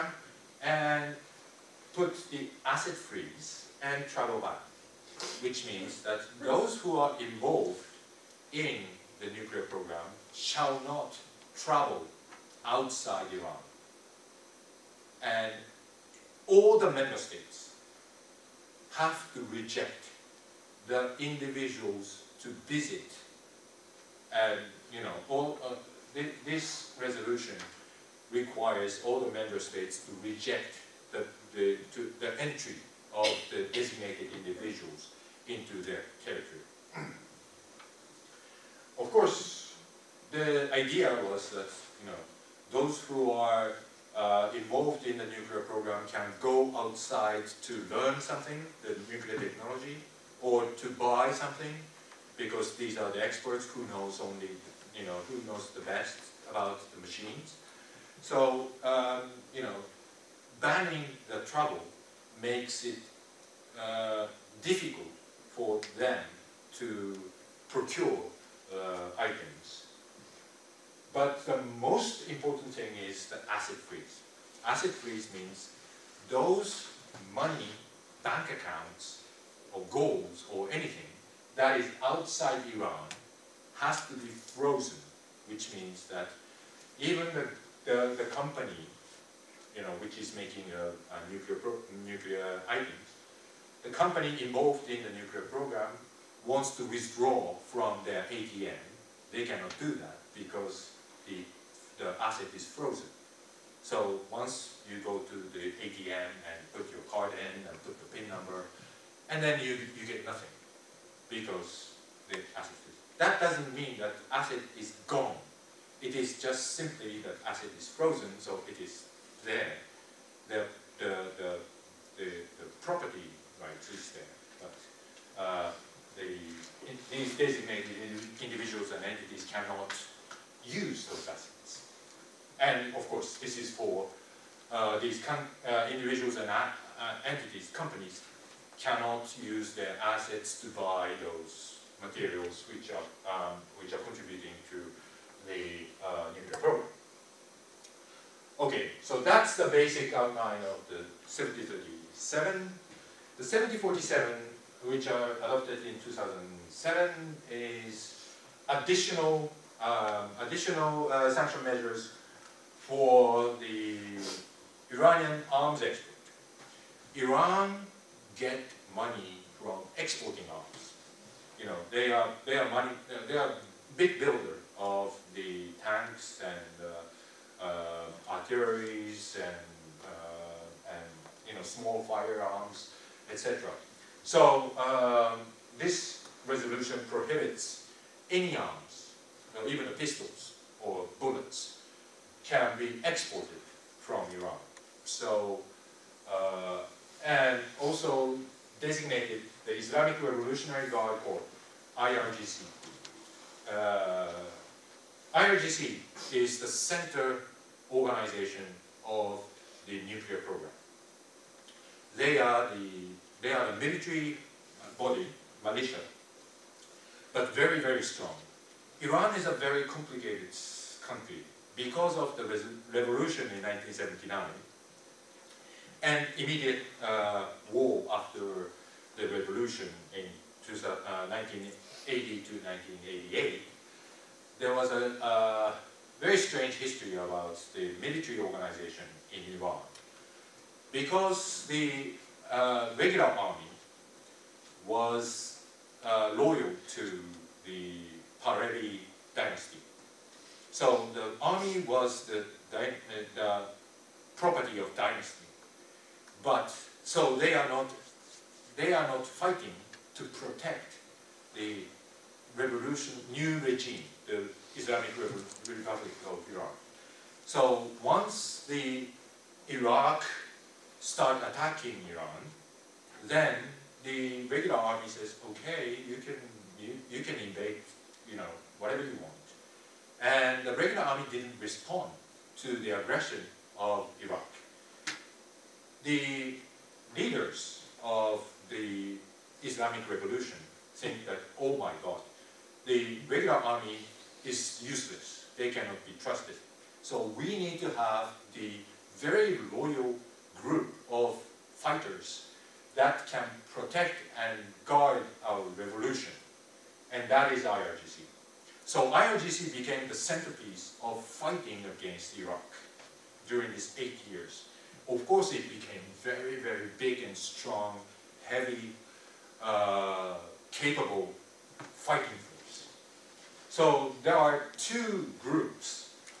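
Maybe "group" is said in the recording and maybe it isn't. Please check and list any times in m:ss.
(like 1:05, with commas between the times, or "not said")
5:00, 5:25.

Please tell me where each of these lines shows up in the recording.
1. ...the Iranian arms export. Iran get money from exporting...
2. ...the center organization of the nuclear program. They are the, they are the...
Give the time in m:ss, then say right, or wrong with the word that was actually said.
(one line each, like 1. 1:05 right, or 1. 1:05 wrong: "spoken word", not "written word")
1. 2:43 right
2. 3:26 right.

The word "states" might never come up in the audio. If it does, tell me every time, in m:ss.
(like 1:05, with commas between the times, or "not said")
0:17, 0:29.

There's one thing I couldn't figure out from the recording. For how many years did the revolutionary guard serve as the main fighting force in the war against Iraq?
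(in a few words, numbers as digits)
8.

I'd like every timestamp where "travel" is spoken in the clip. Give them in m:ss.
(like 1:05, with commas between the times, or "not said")
0:04, 0:11.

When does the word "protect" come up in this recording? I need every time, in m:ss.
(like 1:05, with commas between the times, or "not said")
4:20, 5:03.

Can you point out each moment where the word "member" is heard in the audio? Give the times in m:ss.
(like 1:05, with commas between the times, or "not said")
0:16, 0:29.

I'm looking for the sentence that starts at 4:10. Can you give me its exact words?
So the army was the, the, property of dynasty.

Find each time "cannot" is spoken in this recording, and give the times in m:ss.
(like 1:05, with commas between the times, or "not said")
1:39, 2:09, 2:18, 4:55.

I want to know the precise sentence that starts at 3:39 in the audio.
Iran is a very complicated country because of the revolution in 1979 and immediate uh, war after the revolution in uh, 1980.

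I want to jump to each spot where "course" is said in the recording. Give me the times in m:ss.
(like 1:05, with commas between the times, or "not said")
0:39, 2:13, 5:15.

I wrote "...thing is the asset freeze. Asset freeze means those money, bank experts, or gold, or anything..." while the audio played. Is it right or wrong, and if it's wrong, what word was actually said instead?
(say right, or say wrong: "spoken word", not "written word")
wrong: "accounts", not "experts".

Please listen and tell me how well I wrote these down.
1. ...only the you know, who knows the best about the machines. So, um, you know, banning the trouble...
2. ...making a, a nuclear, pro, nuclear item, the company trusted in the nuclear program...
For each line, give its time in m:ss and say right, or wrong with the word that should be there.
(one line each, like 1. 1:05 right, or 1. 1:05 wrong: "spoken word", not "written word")
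1. 0:54 right
2. 1:30 wrong: "involved", not "trusted".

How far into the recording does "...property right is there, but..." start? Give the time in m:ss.
2:02.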